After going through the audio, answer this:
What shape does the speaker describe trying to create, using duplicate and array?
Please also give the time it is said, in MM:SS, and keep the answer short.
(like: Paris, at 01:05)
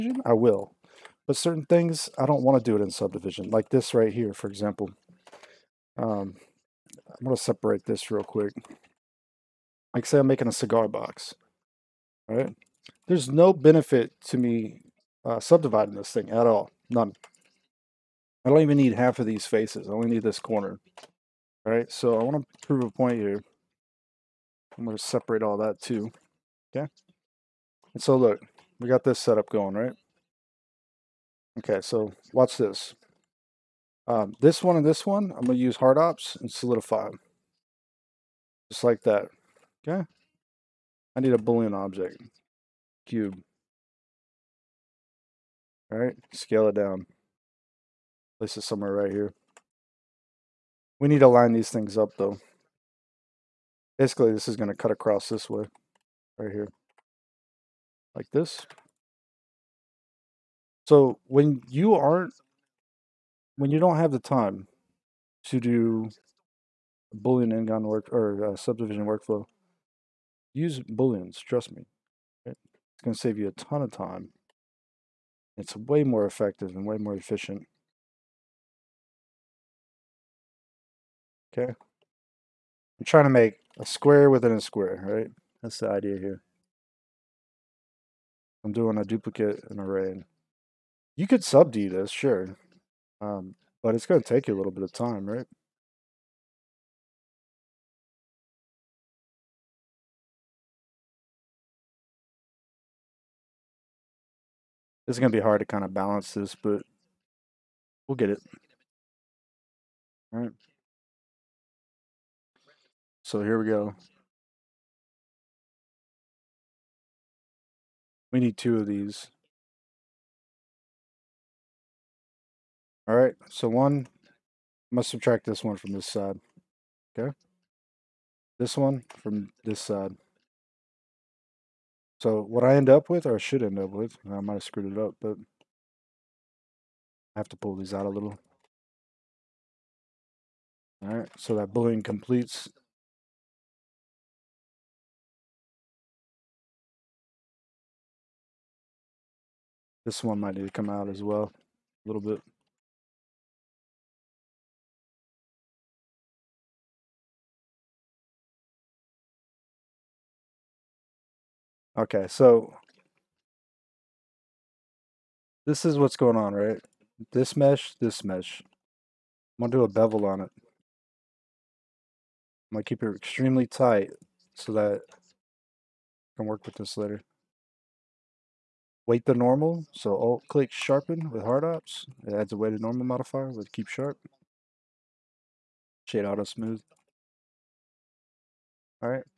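Square within a square, at 01:23.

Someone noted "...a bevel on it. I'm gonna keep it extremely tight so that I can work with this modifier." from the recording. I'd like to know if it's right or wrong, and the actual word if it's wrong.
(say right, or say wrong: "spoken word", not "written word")
wrong: "later", not "modifier".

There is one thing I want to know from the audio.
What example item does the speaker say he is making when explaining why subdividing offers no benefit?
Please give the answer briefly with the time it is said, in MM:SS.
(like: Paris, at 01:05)
Cigar box, at 00:10.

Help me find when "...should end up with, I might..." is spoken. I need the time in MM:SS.
02:13.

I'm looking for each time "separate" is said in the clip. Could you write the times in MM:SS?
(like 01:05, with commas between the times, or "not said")
00:07, 00:25.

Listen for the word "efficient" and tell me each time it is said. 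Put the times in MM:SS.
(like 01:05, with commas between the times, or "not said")
01:17.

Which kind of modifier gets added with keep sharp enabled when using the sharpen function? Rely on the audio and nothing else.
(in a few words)
Weighted normal.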